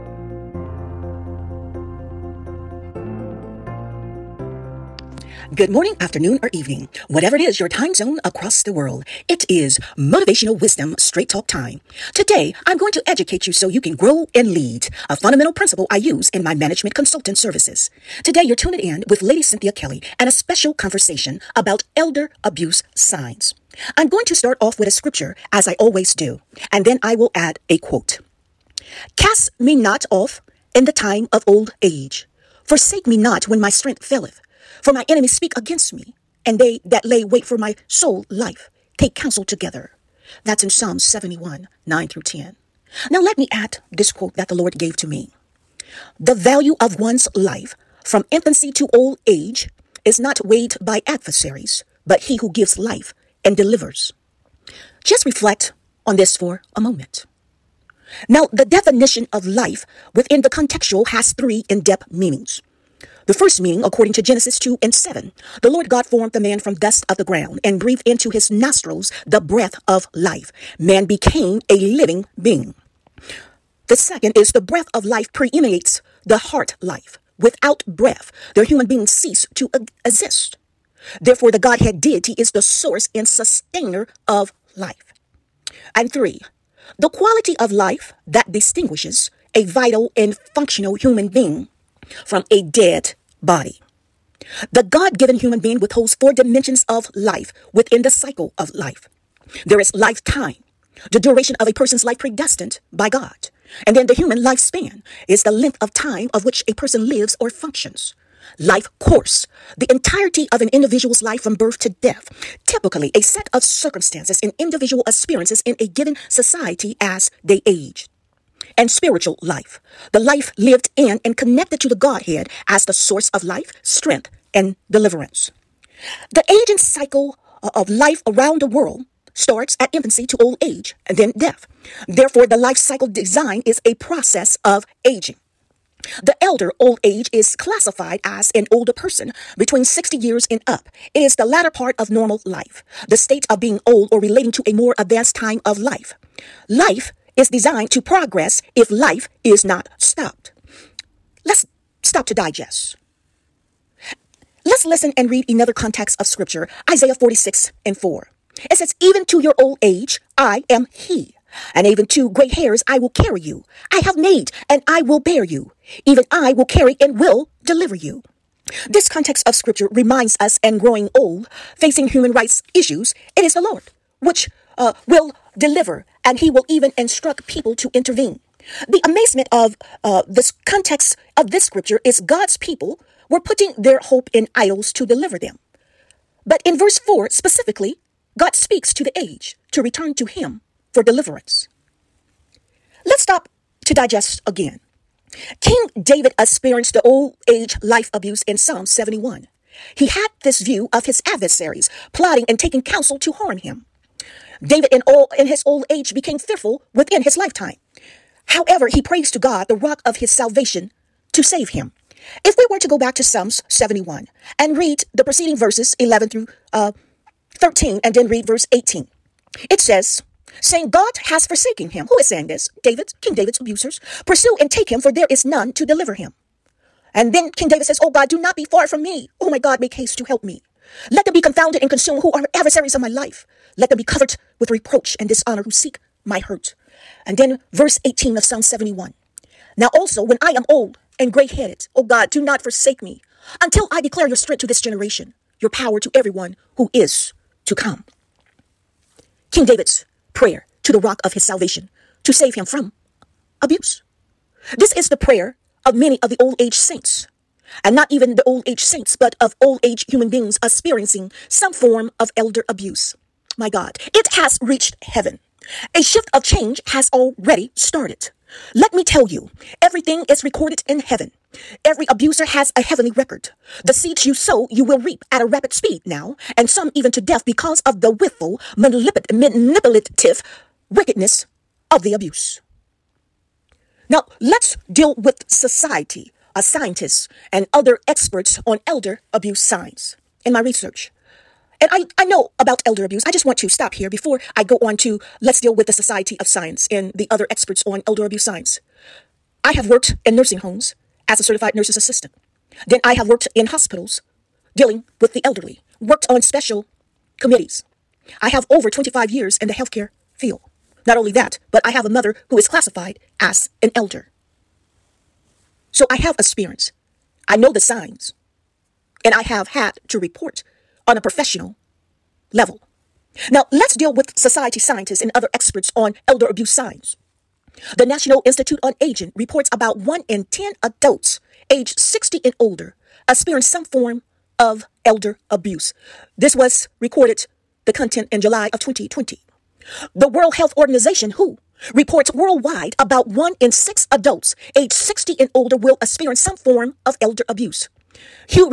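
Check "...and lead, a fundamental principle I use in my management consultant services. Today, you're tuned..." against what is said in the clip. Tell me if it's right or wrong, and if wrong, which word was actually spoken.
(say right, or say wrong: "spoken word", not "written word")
right.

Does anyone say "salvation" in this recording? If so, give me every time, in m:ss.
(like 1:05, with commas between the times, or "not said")
3:30, 4:11.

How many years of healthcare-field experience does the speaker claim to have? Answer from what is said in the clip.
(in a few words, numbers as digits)
25.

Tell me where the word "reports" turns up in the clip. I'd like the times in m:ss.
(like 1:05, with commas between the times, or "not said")
5:20, 5:29, 5:41.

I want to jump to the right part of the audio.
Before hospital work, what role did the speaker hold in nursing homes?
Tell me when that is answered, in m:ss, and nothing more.
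5:01.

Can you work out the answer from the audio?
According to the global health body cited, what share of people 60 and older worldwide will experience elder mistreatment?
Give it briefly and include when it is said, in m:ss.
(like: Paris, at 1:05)
one in six, at 5:43.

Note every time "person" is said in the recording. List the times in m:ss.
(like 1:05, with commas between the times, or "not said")
1:41, 1:46, 2:18.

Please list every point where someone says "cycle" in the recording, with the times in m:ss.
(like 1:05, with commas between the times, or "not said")
1:38, 2:06, 2:12.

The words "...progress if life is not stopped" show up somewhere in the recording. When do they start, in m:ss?
2:28.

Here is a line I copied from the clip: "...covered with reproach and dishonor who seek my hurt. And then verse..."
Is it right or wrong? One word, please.
right.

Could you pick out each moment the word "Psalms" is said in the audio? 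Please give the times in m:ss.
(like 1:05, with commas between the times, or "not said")
0:40, 3:18, 3:33, 3:58.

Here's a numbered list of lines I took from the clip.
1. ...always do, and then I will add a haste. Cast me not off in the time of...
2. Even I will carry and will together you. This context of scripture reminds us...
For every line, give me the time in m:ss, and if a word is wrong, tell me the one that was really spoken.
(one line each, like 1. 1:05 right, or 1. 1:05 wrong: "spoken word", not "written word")
1. 0:25 wrong: "quote", not "haste"
2. 2:46 wrong: "deliver", not "together".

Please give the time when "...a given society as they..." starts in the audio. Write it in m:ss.
1:55.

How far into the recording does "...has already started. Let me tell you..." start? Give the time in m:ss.
4:26.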